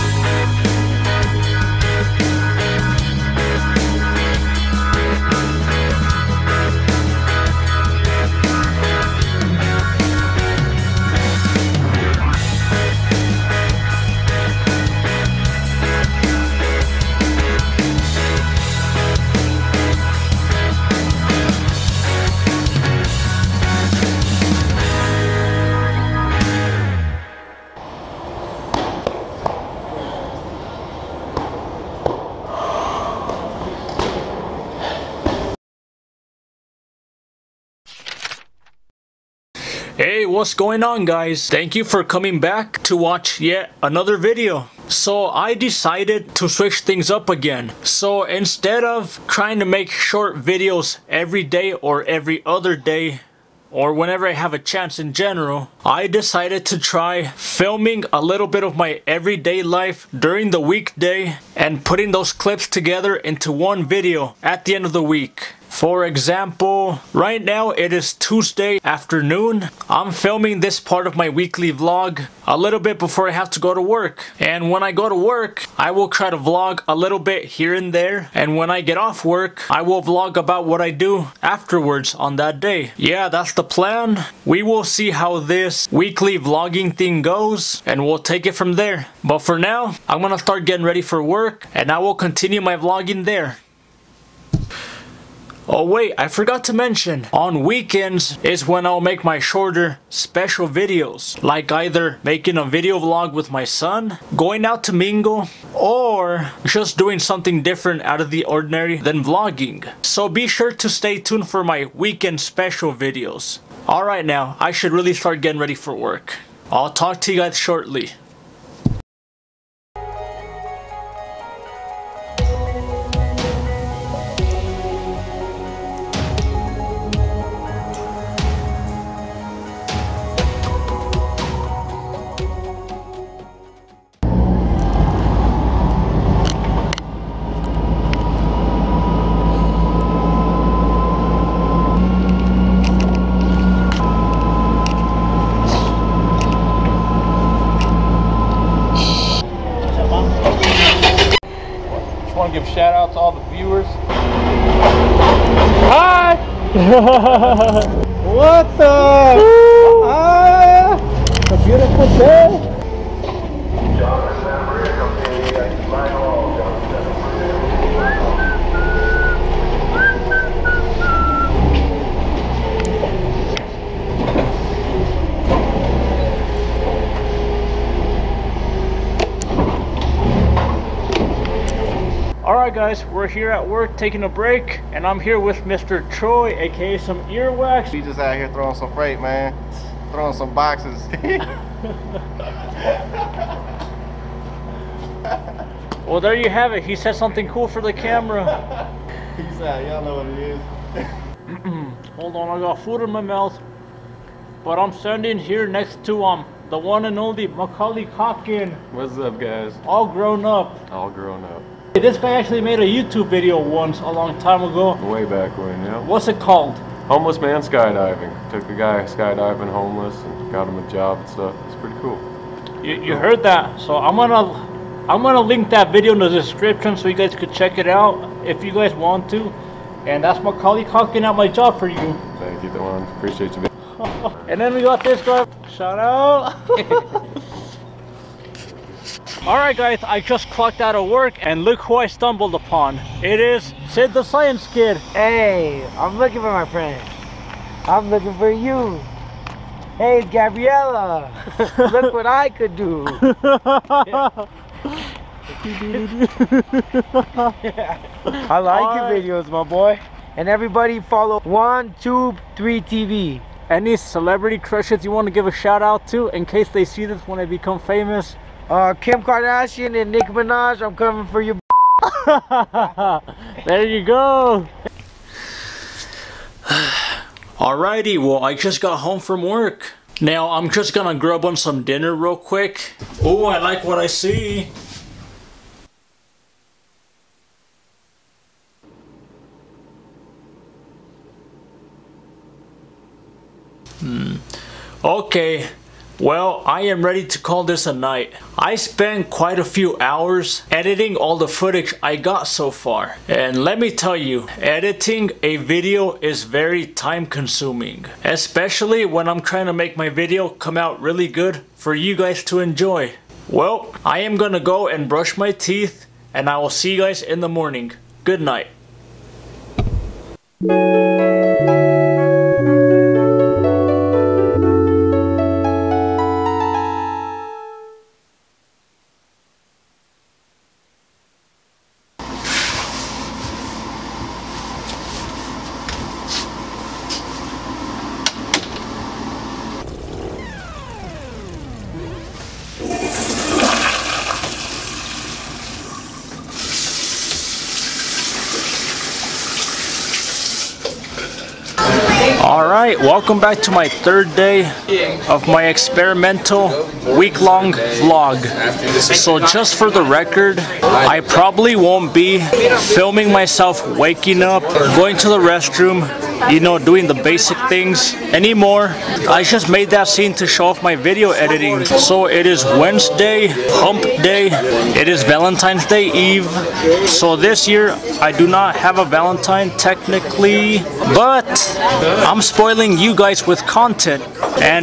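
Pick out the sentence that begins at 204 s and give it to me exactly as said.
But I'm standing here next to um the one and only Macaulay Calkin.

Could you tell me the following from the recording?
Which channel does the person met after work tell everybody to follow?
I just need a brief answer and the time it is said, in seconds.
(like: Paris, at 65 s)
123 TV, at 261 s.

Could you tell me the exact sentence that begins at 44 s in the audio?
So I decided to switch things up again.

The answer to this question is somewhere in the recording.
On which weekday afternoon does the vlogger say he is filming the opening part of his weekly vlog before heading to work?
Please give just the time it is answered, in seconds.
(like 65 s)
68 s.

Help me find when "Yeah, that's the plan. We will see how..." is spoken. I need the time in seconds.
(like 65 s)
82 s.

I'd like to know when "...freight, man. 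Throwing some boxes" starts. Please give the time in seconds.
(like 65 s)
188 s.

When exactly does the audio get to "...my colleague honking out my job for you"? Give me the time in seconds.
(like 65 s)
230 s.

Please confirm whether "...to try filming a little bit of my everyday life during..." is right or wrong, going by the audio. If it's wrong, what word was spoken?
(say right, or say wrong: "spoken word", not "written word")
right.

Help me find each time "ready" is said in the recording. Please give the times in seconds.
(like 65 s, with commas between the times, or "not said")
90 s, 115 s, 297 s.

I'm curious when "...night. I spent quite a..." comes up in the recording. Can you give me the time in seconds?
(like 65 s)
297 s.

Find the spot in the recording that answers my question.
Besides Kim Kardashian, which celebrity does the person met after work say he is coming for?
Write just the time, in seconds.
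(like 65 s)
270 s.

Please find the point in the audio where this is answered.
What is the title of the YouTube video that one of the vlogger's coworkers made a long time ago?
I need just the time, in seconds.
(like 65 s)
217 s.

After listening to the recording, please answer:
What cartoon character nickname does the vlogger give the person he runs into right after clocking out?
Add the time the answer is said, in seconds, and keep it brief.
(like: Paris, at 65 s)
Sid the Science Kid, at 243 s.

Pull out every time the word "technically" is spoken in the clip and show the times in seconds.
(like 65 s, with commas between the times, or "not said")
379 s.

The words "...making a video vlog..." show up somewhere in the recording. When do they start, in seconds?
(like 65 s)
102 s.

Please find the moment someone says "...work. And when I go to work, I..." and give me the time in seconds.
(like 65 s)
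73 s.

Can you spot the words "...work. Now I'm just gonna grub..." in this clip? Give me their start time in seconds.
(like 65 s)
279 s.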